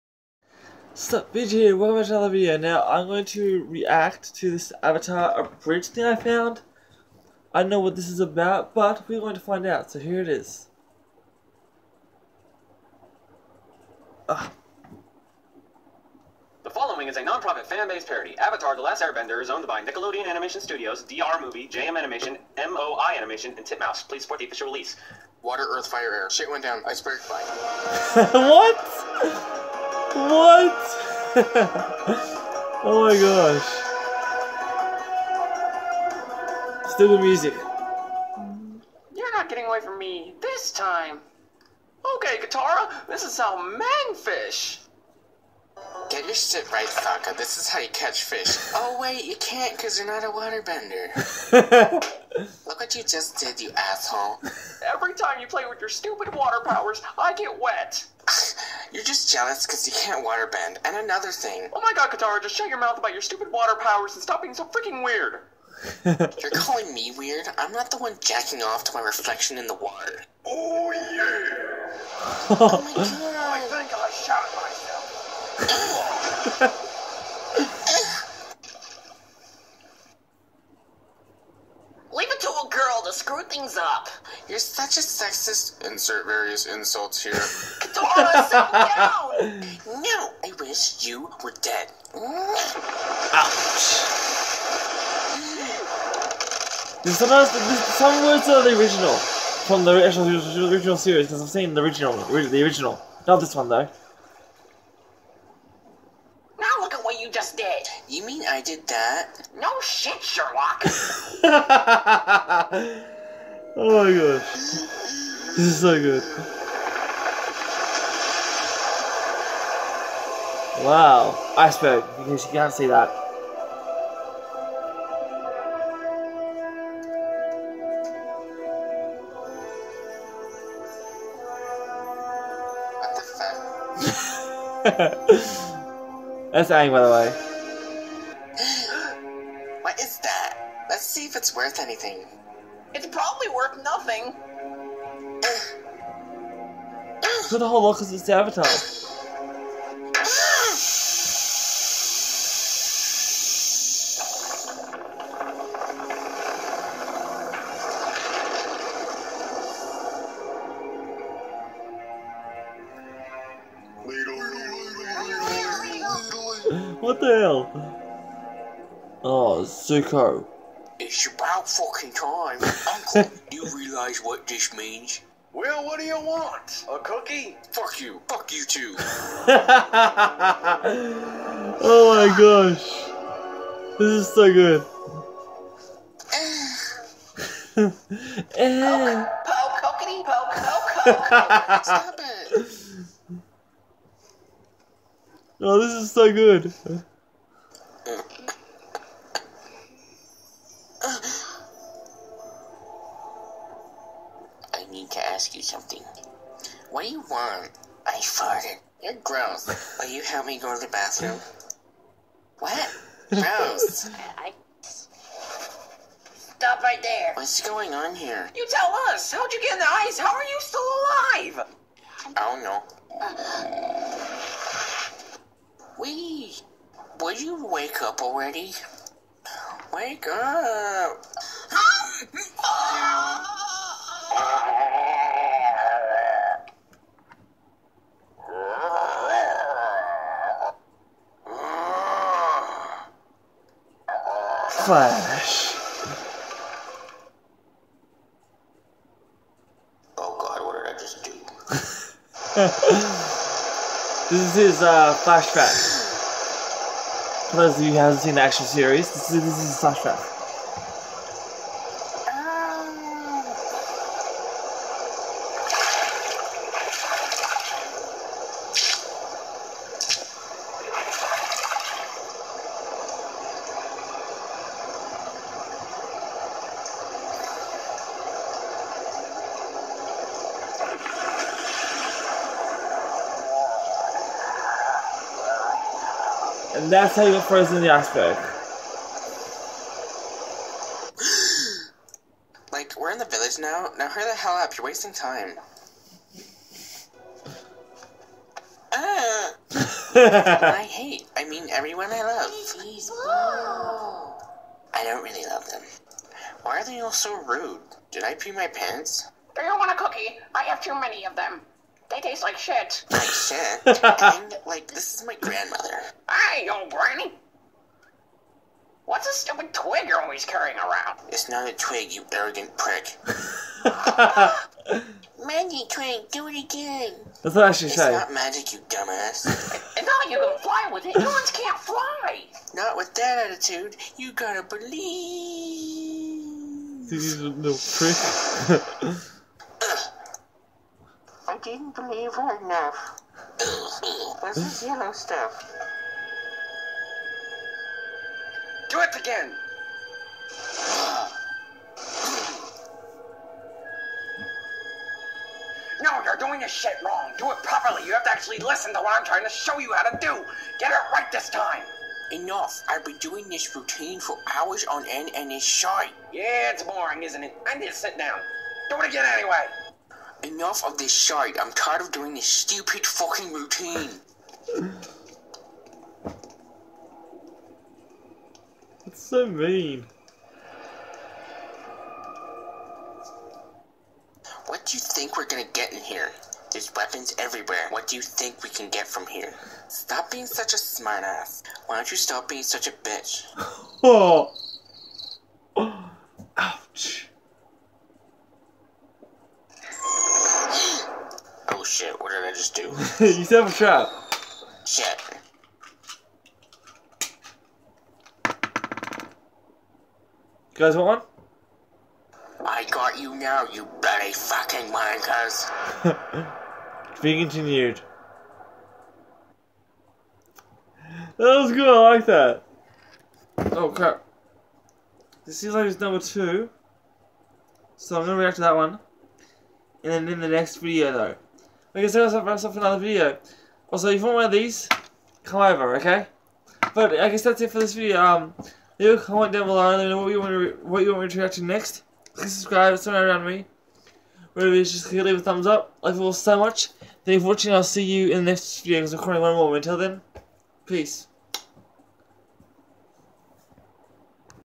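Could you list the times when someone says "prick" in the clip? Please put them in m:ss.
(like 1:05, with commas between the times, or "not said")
5:22, 5:37.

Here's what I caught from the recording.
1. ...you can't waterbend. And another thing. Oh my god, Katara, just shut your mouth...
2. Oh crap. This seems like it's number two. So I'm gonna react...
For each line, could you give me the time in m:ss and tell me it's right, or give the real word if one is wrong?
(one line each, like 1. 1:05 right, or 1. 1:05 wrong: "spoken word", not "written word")
1. 0:59 right
2. 7:03 right.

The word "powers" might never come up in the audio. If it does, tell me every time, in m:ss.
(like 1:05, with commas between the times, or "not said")
0:56, 1:03.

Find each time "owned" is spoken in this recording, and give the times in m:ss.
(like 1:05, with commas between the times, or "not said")
0:19.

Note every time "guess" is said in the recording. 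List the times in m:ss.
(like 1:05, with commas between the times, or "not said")
7:17.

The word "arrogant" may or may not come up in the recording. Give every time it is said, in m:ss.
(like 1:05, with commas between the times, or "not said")
5:22.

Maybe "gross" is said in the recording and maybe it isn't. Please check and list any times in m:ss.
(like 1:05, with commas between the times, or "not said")
3:29, 3:33.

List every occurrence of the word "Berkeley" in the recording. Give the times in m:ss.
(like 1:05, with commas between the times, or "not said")
not said.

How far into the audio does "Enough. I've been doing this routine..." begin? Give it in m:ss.
6:02.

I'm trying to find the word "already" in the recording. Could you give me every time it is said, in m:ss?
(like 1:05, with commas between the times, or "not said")
3:48.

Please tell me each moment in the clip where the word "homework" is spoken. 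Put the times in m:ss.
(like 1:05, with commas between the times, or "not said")
not said.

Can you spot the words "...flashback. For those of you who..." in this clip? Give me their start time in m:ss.
4:15.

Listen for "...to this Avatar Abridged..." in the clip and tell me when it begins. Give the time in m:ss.
0:04.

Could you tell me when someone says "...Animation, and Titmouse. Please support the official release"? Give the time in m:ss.
0:23.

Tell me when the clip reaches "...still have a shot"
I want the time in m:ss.
6:43.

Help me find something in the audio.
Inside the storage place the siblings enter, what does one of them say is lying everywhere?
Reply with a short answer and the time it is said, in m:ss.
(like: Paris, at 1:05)
Weapons, at 6:26.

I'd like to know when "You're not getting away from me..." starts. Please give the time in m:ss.
0:39.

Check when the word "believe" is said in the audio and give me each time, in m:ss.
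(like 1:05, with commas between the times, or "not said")
5:34, 5:41.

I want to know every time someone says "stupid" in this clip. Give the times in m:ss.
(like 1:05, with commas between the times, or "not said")
0:55, 1:03, 5:19, 6:12.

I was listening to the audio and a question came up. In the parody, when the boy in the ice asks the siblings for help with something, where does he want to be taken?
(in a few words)
the bathroom.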